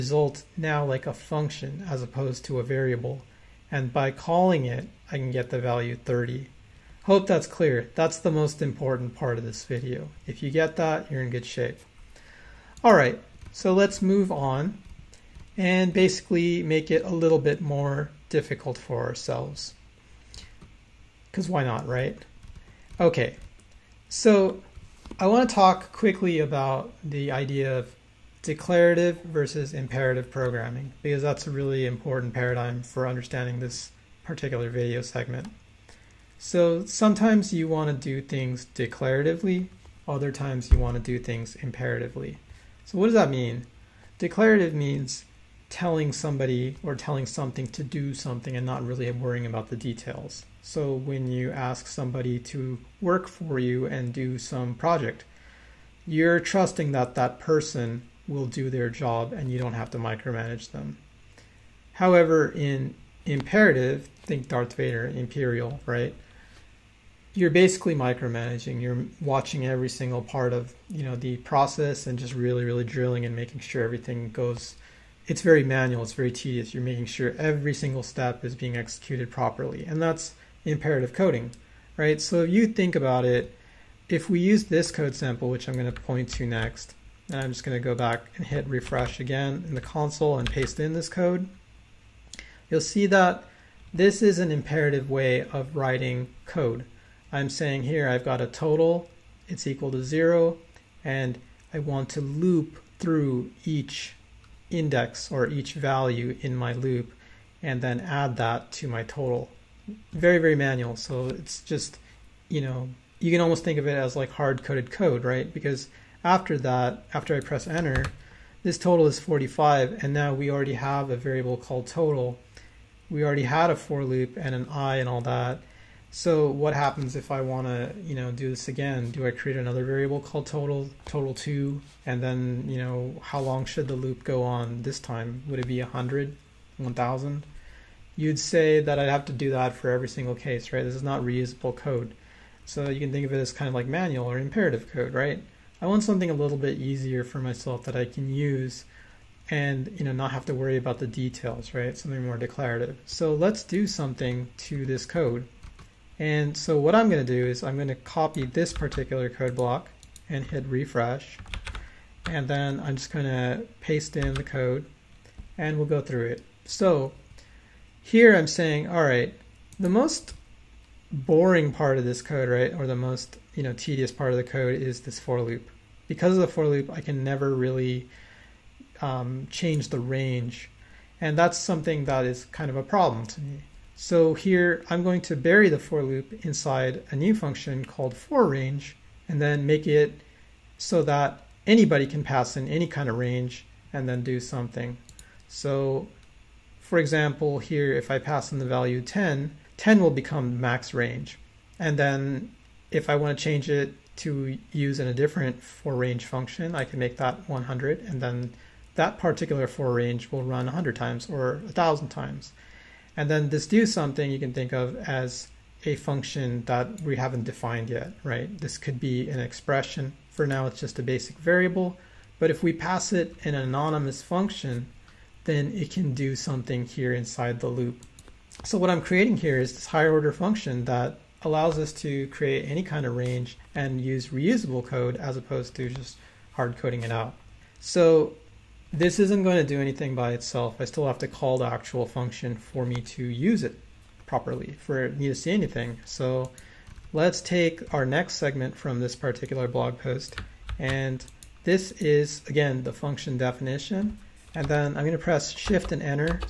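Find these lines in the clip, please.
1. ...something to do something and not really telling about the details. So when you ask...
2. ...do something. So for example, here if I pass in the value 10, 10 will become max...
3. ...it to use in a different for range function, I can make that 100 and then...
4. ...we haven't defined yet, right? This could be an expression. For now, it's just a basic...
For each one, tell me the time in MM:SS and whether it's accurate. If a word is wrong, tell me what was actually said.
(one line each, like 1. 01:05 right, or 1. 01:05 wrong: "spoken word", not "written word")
1. 00:47 wrong: "worrying", not "telling"
2. 03:14 right
3. 03:23 right
4. 03:37 right.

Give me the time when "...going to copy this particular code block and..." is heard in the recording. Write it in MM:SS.
02:37.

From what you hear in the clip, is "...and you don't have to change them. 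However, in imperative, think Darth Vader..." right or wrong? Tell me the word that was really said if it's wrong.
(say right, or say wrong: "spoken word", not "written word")
wrong: "micromanage", not "change".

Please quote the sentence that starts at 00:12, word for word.
All right, so let's move on and basically make it a little bit more difficult for ourselves because why not, right?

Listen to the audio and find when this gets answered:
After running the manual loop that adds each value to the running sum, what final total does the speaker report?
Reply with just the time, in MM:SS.
01:59.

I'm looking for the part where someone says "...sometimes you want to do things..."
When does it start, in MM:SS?
00:36.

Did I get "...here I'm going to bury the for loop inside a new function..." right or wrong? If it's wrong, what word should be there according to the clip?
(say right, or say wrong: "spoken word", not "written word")
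right.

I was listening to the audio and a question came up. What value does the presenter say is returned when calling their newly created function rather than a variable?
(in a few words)
30.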